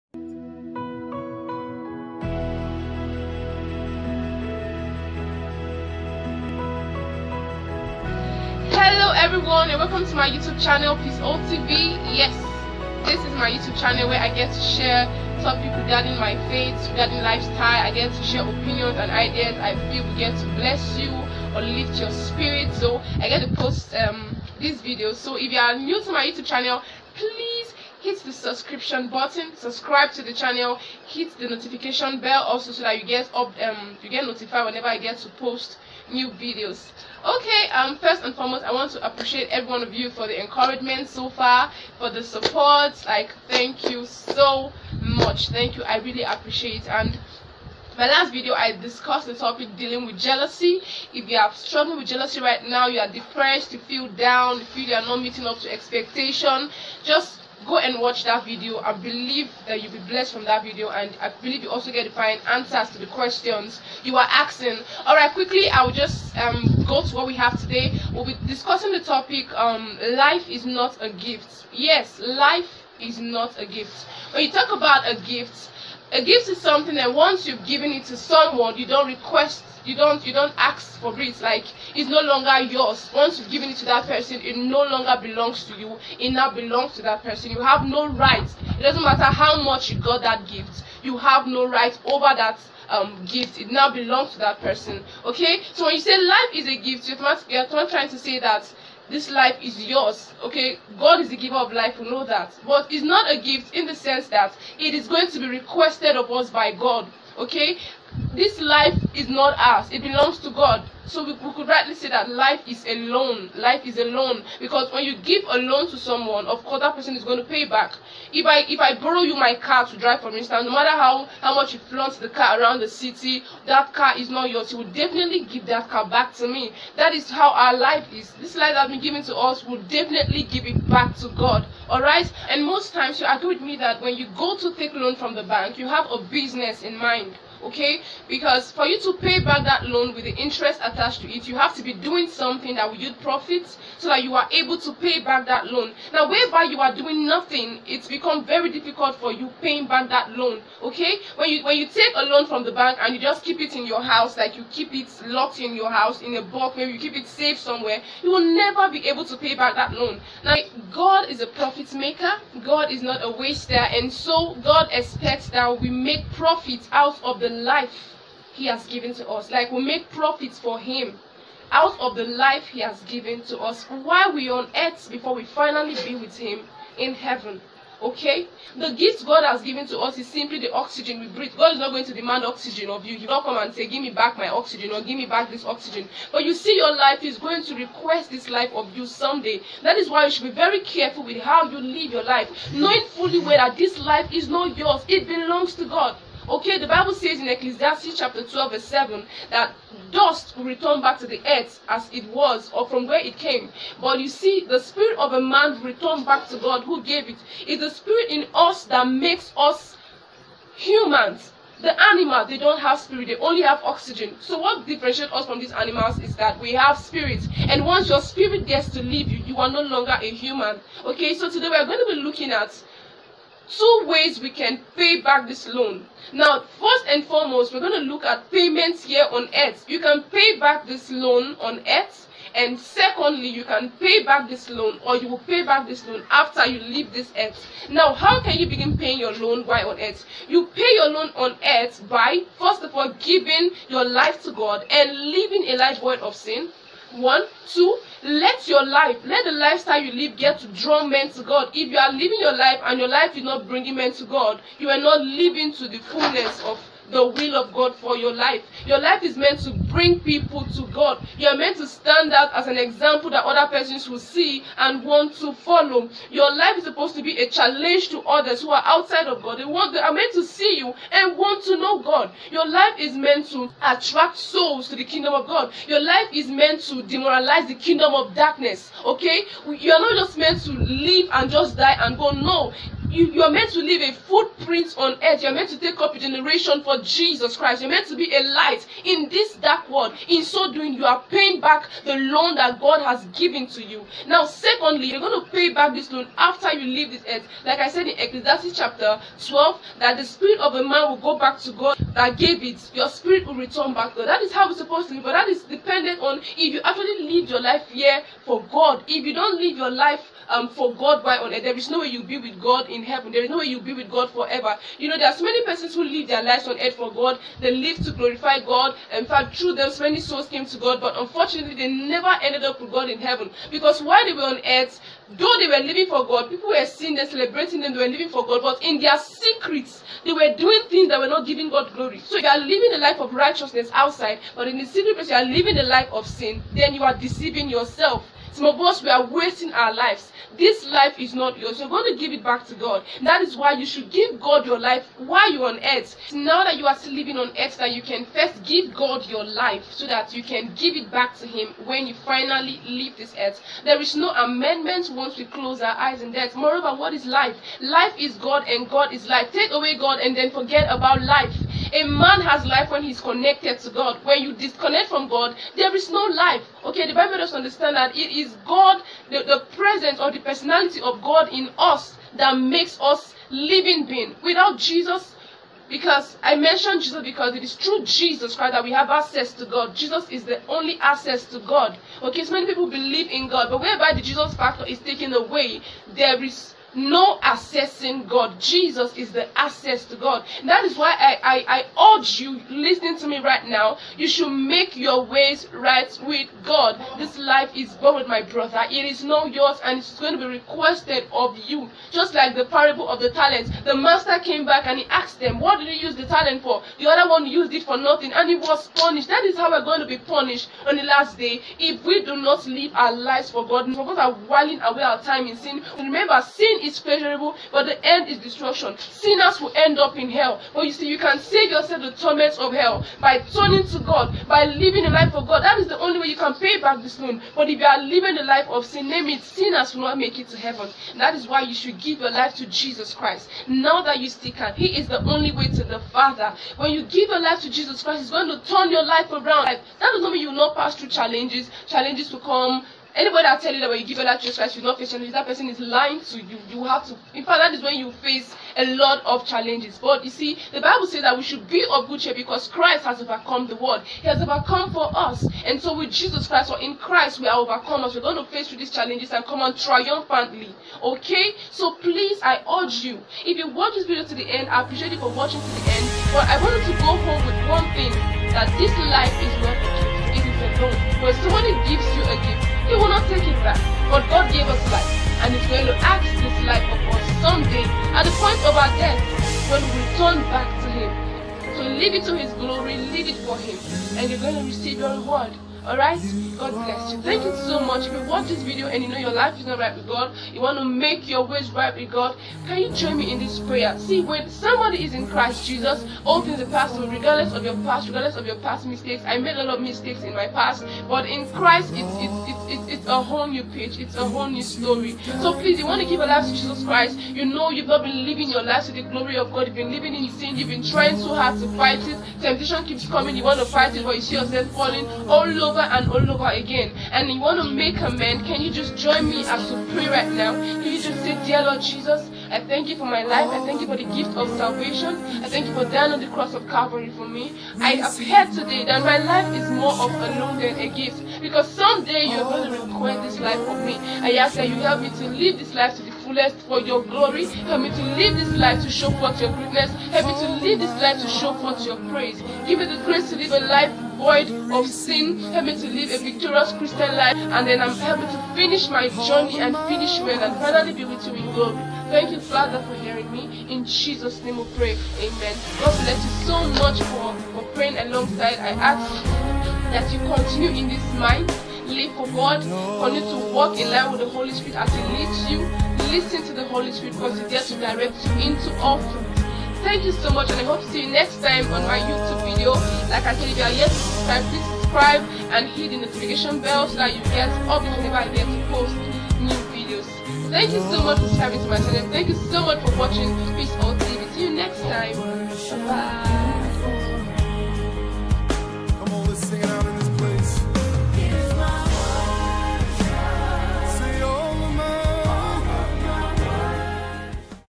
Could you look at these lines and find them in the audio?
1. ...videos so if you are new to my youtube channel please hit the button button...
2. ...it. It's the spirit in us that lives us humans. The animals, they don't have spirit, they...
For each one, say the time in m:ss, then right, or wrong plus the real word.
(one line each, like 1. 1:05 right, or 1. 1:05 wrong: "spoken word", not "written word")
1. 0:24 wrong: "subscription", not "button"
2. 3:27 wrong: "makes", not "lives".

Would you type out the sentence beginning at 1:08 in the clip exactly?
We'll be discussing the topic um, Life is not a gift.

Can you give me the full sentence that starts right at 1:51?
So we, we could rightly say that life is a loan.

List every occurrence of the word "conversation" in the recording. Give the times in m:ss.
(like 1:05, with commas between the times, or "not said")
not said.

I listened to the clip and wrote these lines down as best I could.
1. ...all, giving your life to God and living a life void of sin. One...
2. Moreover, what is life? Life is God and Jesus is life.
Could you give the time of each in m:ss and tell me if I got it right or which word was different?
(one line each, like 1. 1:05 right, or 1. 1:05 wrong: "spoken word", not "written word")
1. 4:02 right
2. 5:56 wrong: "God", not "Jesus".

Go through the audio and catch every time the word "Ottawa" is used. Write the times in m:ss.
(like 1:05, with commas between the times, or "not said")
not said.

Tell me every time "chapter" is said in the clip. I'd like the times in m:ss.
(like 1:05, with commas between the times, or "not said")
3:18, 4:58.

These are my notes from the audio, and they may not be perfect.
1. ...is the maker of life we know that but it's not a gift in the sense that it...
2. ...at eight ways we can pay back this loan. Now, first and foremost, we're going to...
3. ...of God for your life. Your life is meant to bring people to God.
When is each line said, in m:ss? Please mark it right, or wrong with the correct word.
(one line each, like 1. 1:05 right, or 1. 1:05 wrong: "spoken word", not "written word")
1. 1:41 wrong: "giver", not "maker"
2. 3:42 wrong: "two", not "eight"
3. 4:17 right.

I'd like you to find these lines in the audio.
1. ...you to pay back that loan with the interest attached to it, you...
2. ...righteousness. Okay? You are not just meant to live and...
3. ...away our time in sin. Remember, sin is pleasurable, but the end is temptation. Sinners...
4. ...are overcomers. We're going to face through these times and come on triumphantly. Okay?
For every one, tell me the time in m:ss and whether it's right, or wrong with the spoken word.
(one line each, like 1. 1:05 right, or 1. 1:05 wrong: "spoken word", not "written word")
1. 2:18 right
2. 4:38 wrong: "darkness", not "righteousness"
3. 6:54 wrong: "destruction", not "temptation"
4. 7:37 wrong: "challenges", not "times".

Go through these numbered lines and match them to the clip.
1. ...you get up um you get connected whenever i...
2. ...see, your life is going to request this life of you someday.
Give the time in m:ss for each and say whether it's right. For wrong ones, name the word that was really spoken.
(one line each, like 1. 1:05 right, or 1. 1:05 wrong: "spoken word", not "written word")
1. 0:32 wrong: "notified", not "connected"
2. 3:06 right.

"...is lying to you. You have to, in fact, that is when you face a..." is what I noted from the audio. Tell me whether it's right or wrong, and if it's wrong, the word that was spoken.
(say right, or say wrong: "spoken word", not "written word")
right.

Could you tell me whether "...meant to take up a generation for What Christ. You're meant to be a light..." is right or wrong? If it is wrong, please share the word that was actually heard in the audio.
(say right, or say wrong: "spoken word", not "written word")
wrong: "Jesus", not "What".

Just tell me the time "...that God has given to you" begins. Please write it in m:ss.
4:52.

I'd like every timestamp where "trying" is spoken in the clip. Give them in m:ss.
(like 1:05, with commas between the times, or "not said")
1:37, 8:30.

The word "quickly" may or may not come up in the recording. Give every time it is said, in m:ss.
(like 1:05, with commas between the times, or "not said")
1:05.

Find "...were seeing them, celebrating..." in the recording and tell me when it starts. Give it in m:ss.
5:26.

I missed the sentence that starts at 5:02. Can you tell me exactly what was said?
Your spirit will return back to God.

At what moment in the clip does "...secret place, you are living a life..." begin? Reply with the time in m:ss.
5:34.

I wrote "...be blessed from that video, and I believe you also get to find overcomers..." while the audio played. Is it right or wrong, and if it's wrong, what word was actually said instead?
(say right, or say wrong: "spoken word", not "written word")
wrong: "answers", not "overcomers".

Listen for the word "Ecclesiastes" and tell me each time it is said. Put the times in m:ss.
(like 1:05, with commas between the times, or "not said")
3:17, 4:58.